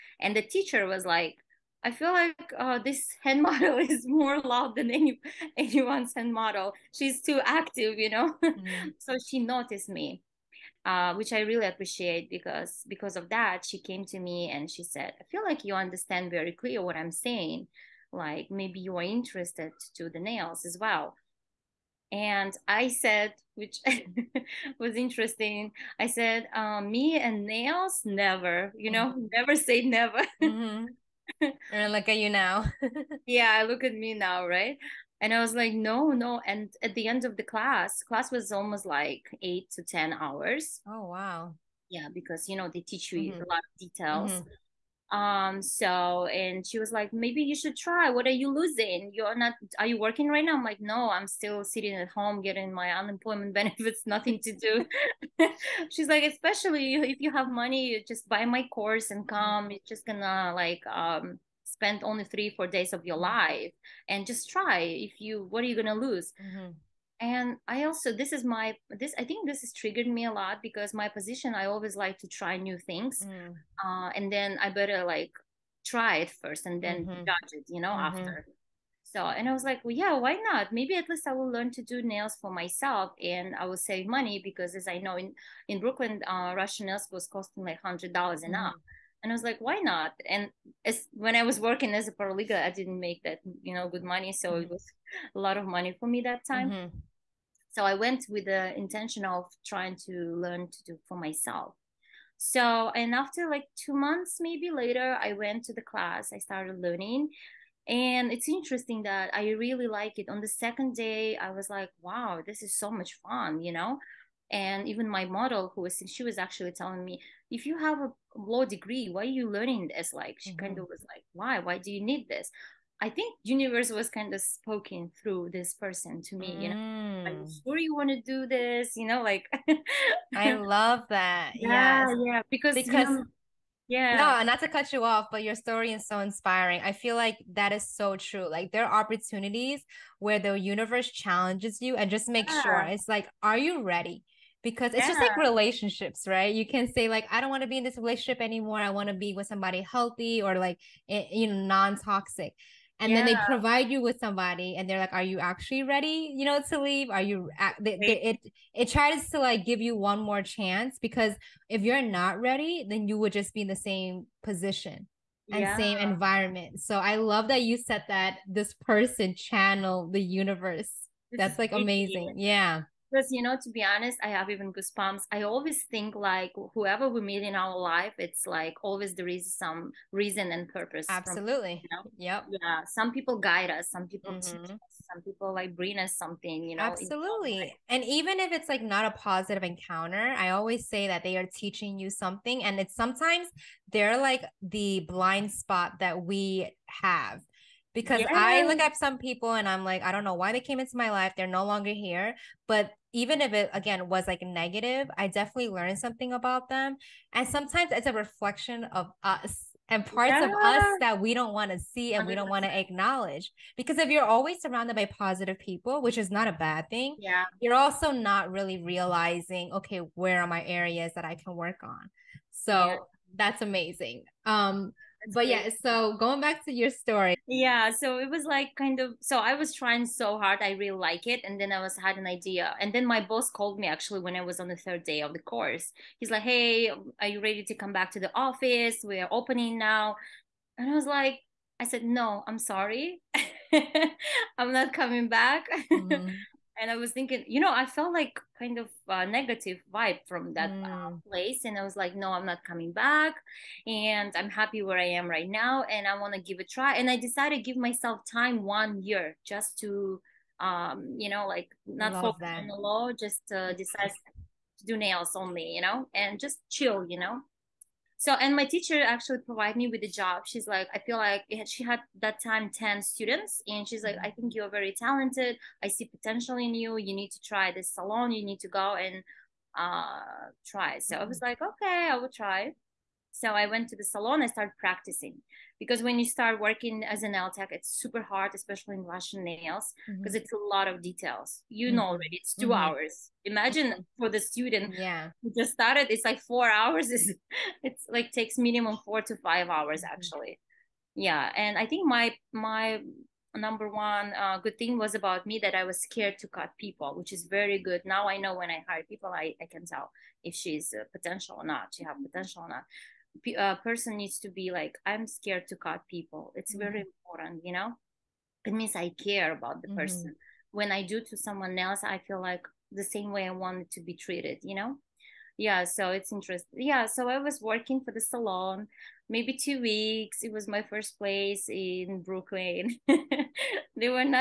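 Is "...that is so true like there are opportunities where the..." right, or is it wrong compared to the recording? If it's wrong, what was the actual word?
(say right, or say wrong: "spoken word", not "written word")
right.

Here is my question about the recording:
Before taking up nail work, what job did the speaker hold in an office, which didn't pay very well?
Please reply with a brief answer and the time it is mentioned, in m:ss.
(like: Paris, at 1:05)
Paralegal, at 1:32.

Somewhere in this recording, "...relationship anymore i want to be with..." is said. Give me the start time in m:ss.
2:27.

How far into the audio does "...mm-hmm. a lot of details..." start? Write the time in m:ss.
0:43.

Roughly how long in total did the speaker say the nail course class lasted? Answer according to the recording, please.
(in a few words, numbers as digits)
8 to 10 hours.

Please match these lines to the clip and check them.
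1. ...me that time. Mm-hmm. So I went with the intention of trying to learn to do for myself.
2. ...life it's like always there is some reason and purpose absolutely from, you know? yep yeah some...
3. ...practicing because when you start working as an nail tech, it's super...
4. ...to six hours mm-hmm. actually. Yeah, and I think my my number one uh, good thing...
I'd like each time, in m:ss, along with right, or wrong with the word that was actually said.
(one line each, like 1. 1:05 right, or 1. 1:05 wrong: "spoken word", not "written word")
1. 1:36 right
2. 2:57 right
3. 4:44 right
4. 4:59 wrong: "five", not "six".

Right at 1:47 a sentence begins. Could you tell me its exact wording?
And it's interesting that I really like it.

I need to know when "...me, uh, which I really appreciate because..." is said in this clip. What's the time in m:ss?
0:09.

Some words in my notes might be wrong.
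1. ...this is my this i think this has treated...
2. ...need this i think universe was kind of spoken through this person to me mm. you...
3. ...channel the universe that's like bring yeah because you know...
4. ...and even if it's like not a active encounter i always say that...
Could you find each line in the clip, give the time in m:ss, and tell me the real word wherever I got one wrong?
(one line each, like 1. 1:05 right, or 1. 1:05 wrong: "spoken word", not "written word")
1. 1:08 wrong: "triggered", not "treated"
2. 2:02 right
3. 2:49 wrong: "amazing", not "bring"
4. 3:07 wrong: "positive", not "active".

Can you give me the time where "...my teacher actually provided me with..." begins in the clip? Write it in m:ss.
4:28.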